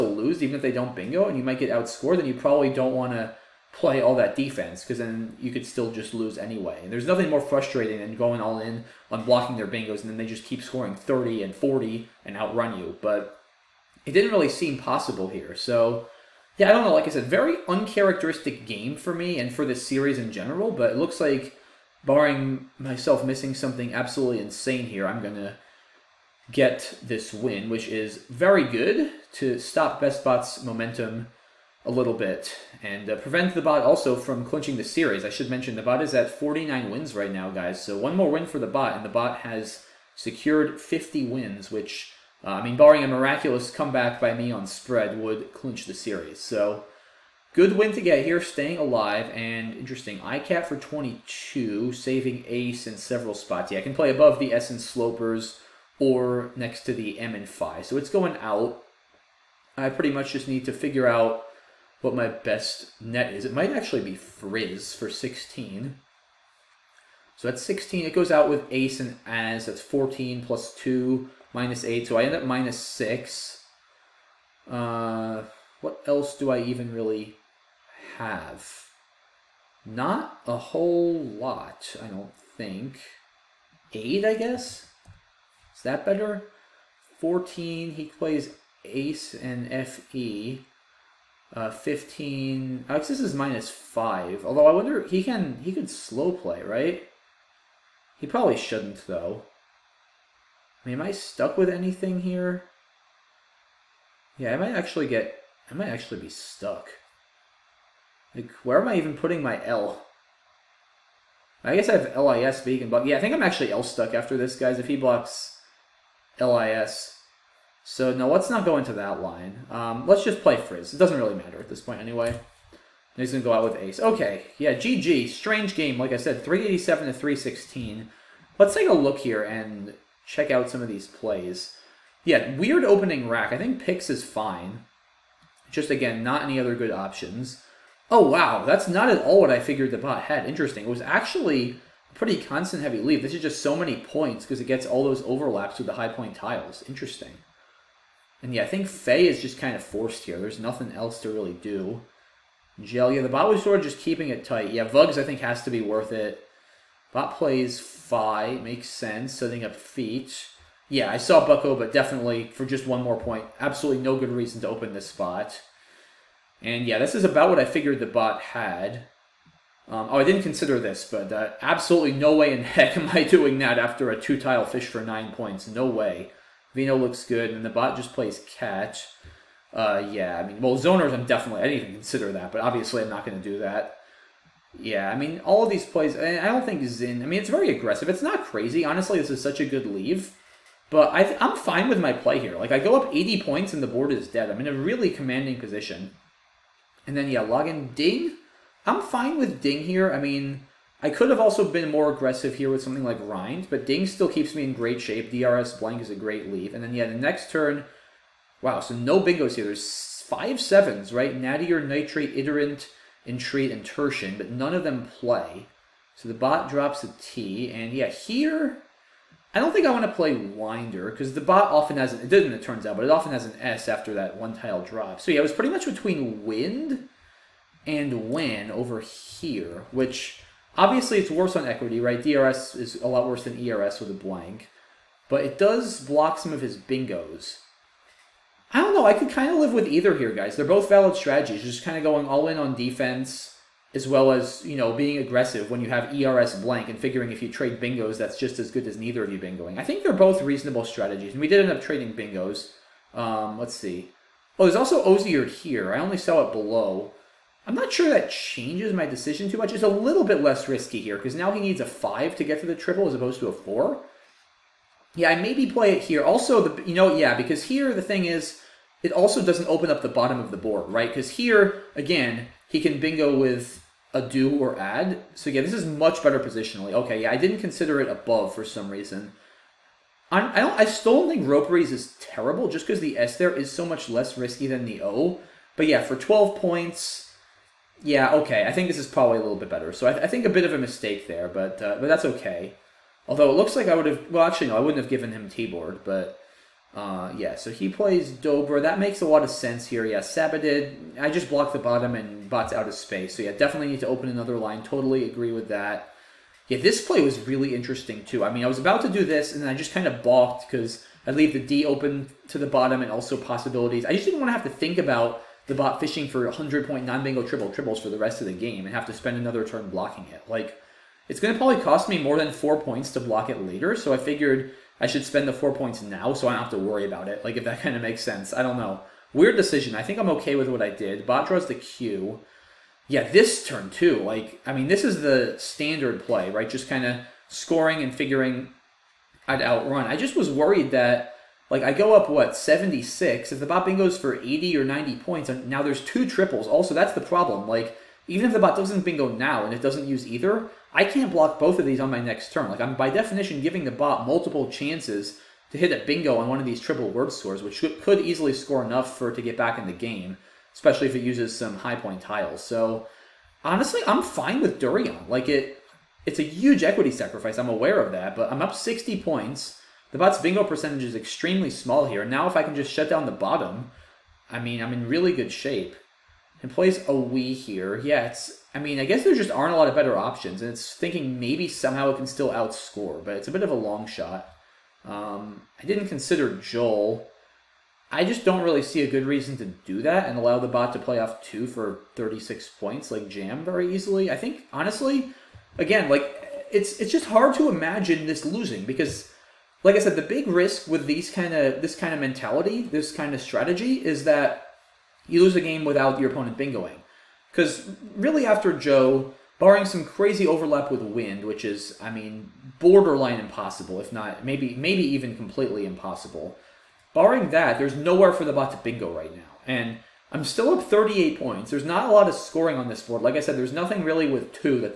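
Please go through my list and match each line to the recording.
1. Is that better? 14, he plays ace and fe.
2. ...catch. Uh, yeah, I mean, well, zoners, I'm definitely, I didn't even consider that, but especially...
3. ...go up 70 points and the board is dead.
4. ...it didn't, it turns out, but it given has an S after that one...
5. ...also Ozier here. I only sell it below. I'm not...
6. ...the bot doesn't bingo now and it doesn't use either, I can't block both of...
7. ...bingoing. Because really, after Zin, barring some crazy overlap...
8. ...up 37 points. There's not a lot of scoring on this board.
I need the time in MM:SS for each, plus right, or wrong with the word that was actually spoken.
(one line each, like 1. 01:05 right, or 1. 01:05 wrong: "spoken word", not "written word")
1. 01:25 right
2. 02:58 wrong: "obviously", not "especially"
3. 03:12 wrong: "80", not "70"
4. 03:42 wrong: "often", not "given"
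5. 04:14 right
6. 05:48 right
7. 06:46 wrong: "Joe", not "Zin"
8. 07:00 wrong: "38", not "37".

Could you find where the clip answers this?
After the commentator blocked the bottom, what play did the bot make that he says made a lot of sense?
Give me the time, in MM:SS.
04:58.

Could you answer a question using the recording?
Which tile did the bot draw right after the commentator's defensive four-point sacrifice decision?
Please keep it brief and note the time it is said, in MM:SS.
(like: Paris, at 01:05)
Q, at 05:31.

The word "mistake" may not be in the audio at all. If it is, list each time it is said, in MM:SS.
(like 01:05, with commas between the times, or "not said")
04:50.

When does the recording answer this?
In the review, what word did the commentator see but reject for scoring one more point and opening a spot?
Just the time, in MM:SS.
02:41.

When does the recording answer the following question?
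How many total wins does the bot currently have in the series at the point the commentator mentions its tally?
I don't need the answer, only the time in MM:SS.
00:36.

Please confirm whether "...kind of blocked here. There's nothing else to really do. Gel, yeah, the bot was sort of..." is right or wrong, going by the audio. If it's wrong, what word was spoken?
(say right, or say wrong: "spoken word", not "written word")
wrong: "forced", not "blocked".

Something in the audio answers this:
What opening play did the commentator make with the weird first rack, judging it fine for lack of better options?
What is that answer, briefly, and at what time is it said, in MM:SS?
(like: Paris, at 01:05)
Pyx, at 02:13.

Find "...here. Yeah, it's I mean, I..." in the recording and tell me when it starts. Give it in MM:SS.
06:17.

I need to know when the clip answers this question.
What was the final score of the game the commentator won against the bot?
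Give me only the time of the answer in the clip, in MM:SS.
02:06.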